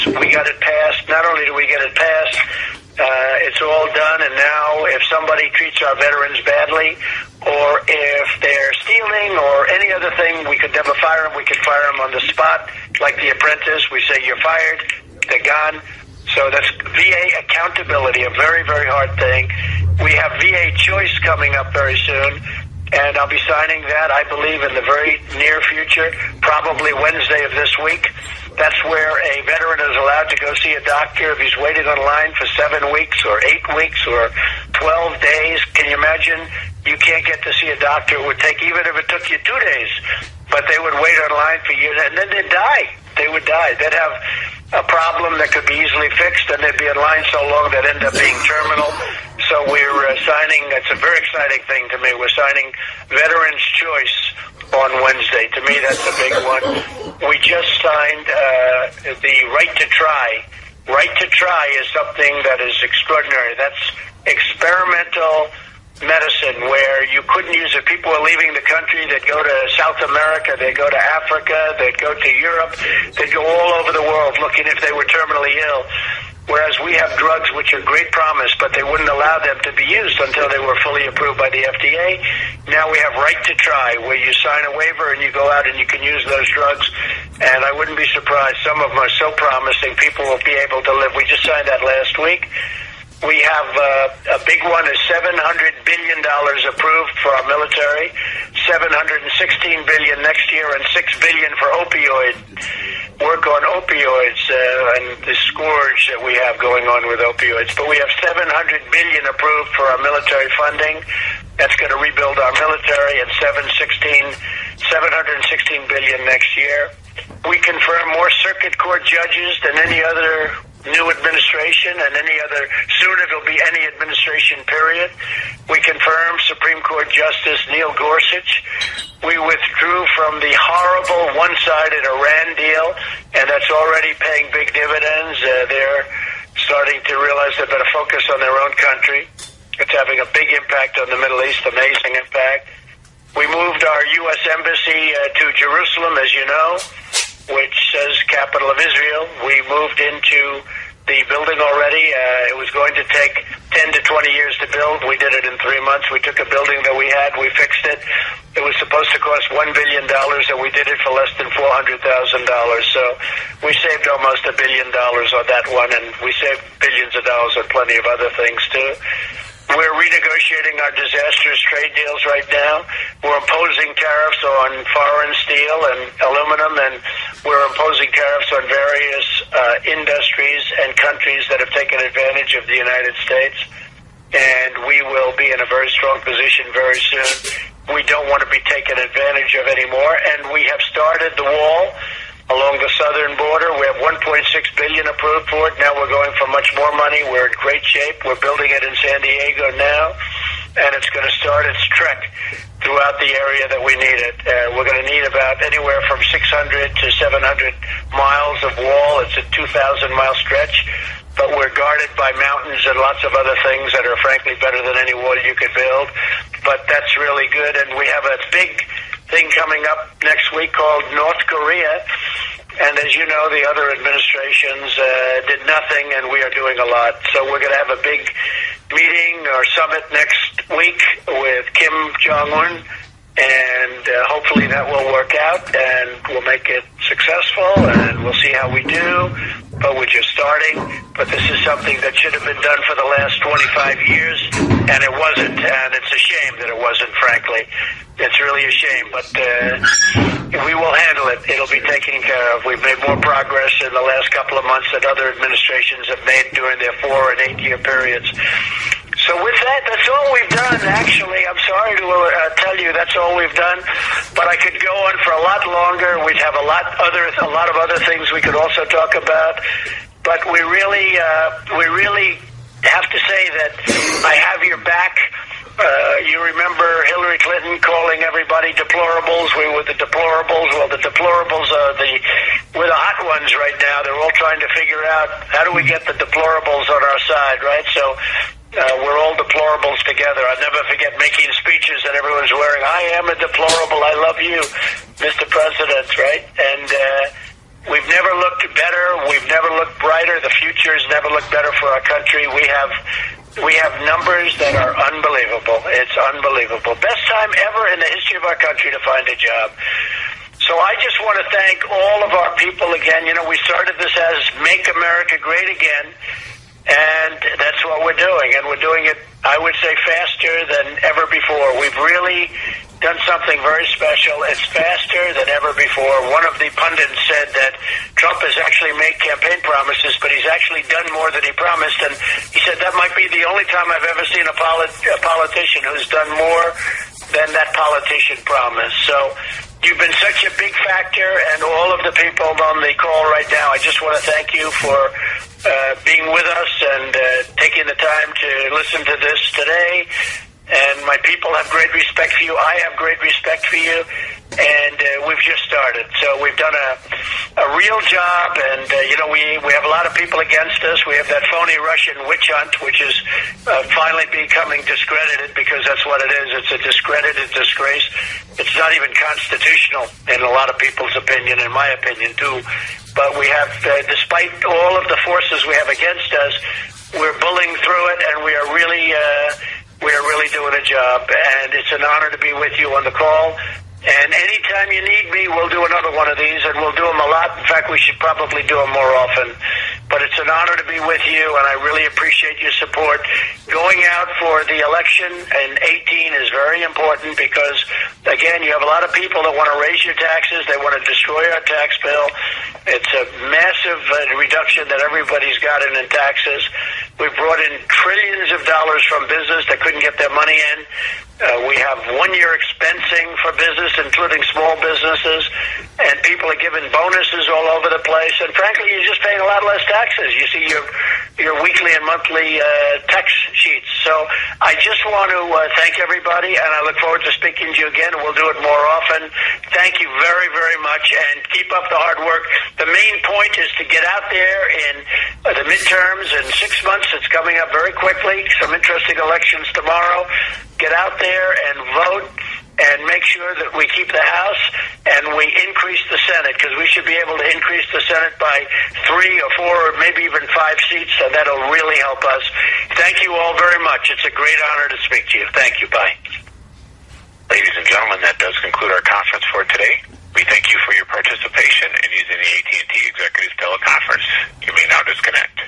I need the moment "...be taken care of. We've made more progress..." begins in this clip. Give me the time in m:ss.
4:11.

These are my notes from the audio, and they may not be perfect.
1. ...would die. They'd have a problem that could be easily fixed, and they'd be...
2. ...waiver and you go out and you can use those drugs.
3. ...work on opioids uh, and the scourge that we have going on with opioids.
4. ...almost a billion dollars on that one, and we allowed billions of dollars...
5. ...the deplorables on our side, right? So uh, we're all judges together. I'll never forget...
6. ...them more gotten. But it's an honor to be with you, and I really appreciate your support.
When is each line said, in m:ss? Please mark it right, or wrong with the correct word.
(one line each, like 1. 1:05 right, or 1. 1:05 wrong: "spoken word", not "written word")
1. 0:43 right
2. 1:24 right
3. 1:43 right
4. 2:44 wrong: "saved", not "allowed"
5. 4:46 wrong: "deplorables", not "judges"
6. 6:28 wrong: "often", not "gotten".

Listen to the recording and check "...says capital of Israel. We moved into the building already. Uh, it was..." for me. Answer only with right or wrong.
right.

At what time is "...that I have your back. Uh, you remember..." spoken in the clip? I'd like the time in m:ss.
4:33.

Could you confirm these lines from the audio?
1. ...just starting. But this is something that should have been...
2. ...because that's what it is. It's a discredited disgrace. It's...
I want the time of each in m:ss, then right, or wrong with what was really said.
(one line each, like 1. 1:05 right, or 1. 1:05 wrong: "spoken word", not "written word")
1. 4:00 right
2. 6:05 right.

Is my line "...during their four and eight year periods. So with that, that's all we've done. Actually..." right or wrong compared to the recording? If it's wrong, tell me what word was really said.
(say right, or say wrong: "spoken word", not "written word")
right.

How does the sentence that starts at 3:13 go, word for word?
We have 1.6 billion approved for it.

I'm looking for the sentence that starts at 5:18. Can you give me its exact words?
And we're doing it, I would say, faster than ever before.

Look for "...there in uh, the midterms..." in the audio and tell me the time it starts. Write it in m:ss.
7:14.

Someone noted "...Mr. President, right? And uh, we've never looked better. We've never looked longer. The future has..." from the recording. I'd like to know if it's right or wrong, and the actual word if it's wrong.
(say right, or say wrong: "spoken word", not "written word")
wrong: "brighter", not "longer".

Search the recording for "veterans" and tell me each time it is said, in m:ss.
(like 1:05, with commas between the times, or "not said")
0:05, 0:29, 0:53.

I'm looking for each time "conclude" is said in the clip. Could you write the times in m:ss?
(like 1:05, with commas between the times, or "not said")
7:38.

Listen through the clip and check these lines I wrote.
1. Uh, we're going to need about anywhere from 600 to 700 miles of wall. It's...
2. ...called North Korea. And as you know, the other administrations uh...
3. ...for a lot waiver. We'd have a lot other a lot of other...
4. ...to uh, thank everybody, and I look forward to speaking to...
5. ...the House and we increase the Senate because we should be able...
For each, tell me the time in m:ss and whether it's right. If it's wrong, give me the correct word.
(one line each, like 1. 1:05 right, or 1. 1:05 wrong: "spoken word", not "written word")
1. 3:24 right
2. 3:40 right
3. 4:25 wrong: "longer", not "waiver"
4. 7:05 right
5. 7:24 right.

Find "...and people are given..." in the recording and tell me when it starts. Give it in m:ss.
6:55.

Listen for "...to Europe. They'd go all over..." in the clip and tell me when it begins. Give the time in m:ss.
1:12.